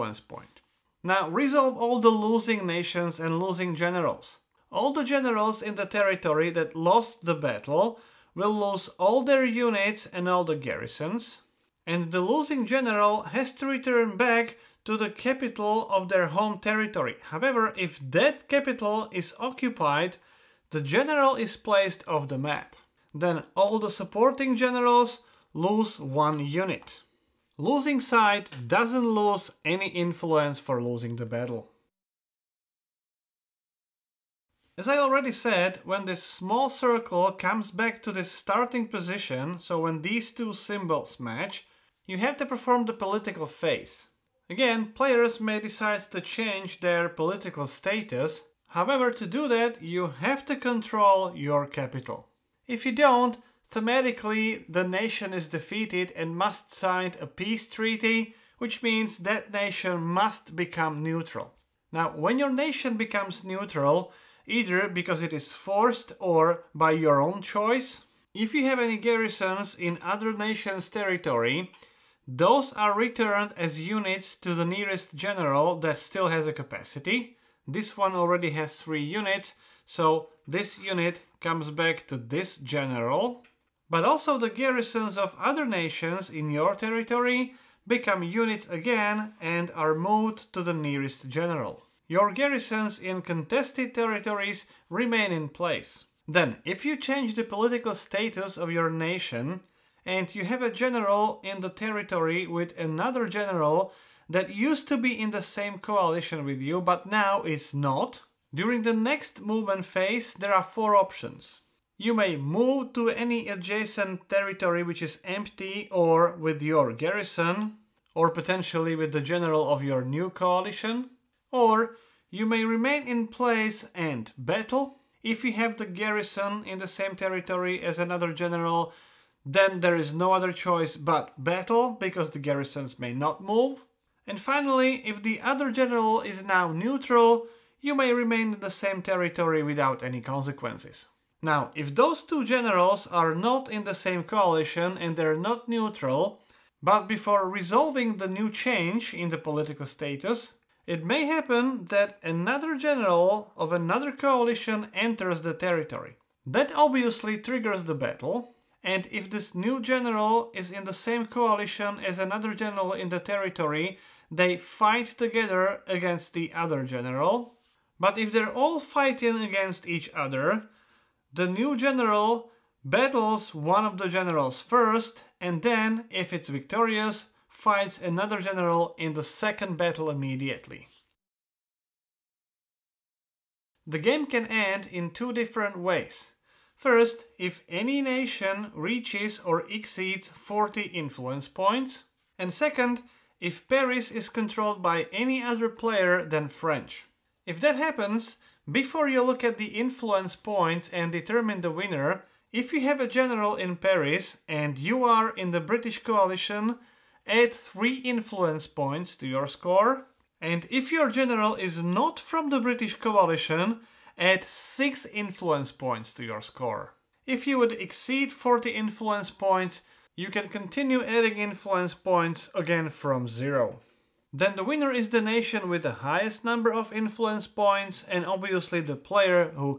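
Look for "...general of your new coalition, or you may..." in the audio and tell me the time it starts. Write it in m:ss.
1:59.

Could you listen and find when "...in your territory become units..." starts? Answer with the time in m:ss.
1:26.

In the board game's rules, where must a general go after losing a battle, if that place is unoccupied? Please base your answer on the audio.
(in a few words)
capital of their home territory.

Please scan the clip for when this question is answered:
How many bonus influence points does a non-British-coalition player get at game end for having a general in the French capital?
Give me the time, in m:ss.
3:34.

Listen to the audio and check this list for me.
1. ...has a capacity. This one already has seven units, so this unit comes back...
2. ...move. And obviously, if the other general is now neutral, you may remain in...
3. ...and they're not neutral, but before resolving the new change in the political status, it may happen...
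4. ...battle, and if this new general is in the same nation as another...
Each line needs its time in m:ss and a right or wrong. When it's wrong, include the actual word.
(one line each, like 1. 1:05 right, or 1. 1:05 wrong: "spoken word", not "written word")
1. 1:16 wrong: "three", not "seven"
2. 2:13 wrong: "finally", not "obviously"
3. 2:24 right
4. 2:37 wrong: "coalition", not "nation".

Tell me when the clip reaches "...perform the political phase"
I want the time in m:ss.
0:42.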